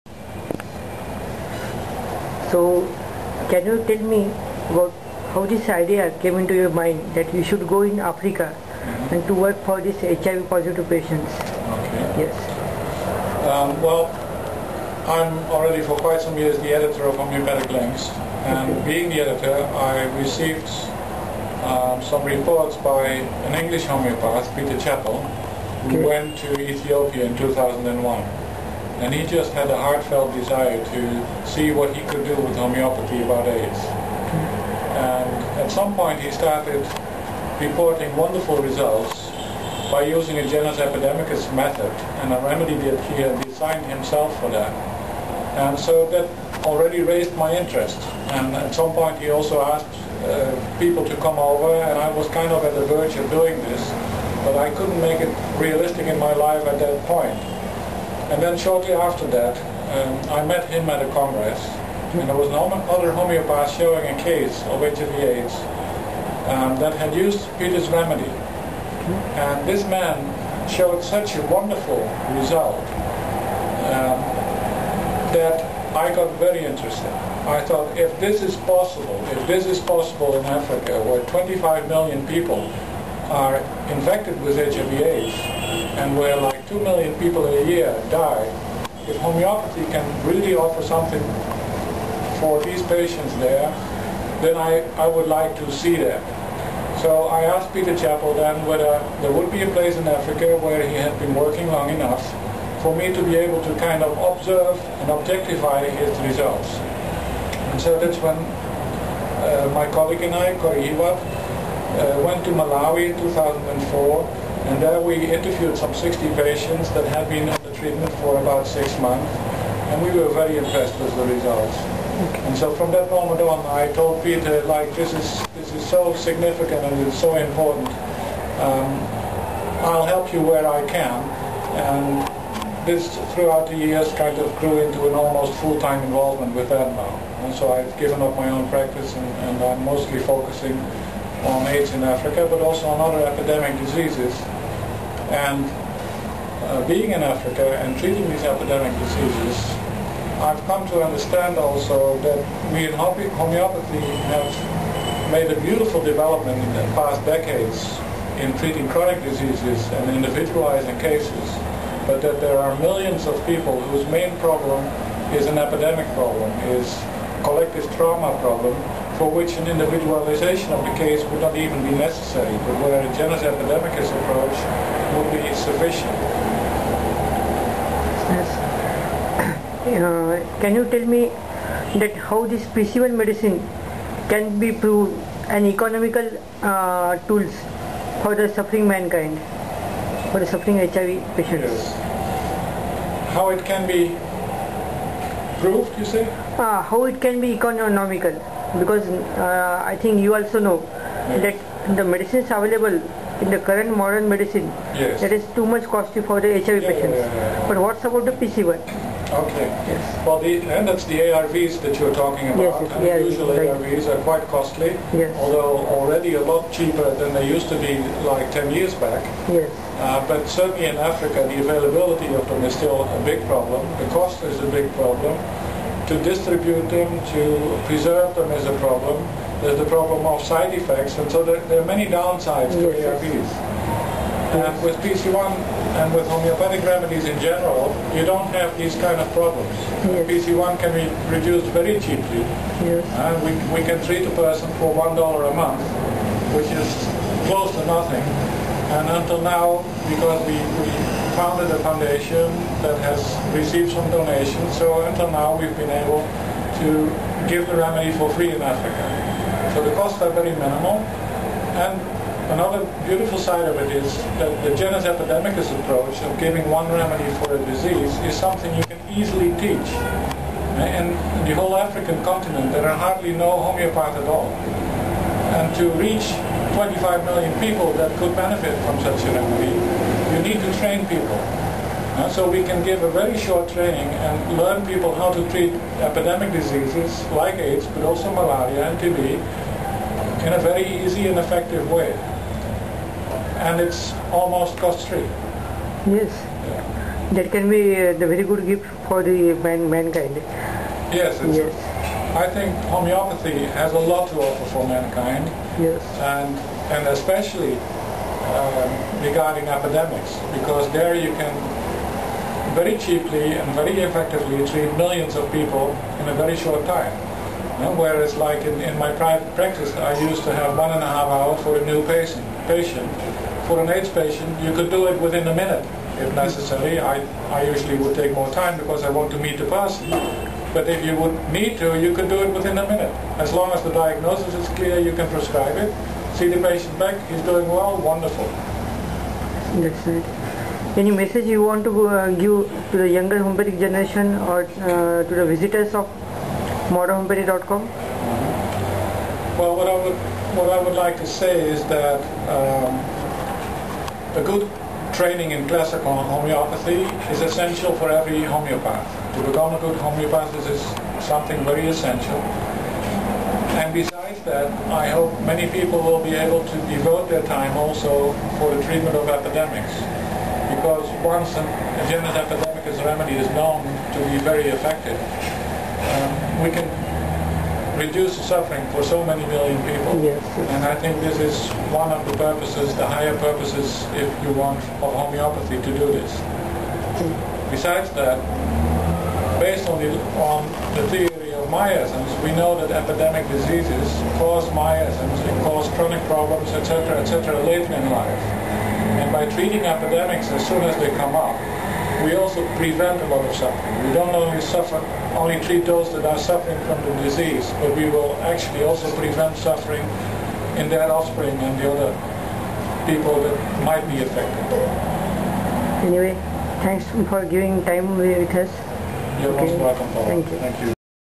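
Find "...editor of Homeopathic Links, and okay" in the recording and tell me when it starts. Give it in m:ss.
0:16.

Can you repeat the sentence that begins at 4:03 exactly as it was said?
and we, we can treat a person for $1 a month, which is close to nothing.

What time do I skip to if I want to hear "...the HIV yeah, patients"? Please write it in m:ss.
3:26.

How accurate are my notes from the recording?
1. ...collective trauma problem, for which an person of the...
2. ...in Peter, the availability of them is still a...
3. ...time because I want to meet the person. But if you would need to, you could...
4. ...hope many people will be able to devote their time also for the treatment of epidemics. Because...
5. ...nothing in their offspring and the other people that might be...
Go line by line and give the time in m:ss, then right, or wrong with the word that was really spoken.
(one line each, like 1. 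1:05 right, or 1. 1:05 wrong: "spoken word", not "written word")
1. 2:47 wrong: "individualization", not "person"
2. 3:40 wrong: "Africa", not "Peter"
3. 5:28 right
4. 6:05 right
5. 6:49 wrong: "suffering", not "nothing".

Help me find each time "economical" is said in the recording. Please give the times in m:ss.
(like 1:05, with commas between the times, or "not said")
3:05, 3:17.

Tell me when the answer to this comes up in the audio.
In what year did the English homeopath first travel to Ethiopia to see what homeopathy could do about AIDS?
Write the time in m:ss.
0:27.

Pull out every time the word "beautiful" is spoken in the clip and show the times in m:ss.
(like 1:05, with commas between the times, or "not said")
2:35, 4:23.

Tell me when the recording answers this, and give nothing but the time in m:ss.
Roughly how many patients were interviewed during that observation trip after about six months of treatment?
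1:55.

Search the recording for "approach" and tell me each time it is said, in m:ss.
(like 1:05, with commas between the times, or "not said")
2:54, 4:25.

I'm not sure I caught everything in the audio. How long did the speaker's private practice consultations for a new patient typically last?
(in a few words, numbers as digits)
1.5 hours.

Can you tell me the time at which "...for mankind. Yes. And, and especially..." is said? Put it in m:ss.
5:04.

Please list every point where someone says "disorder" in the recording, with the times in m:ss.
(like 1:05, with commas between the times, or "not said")
not said.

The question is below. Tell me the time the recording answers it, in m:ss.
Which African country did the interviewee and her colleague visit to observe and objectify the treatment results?
1:52.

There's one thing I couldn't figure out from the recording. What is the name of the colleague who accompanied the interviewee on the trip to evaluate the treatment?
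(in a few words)
Corrie Hiwat.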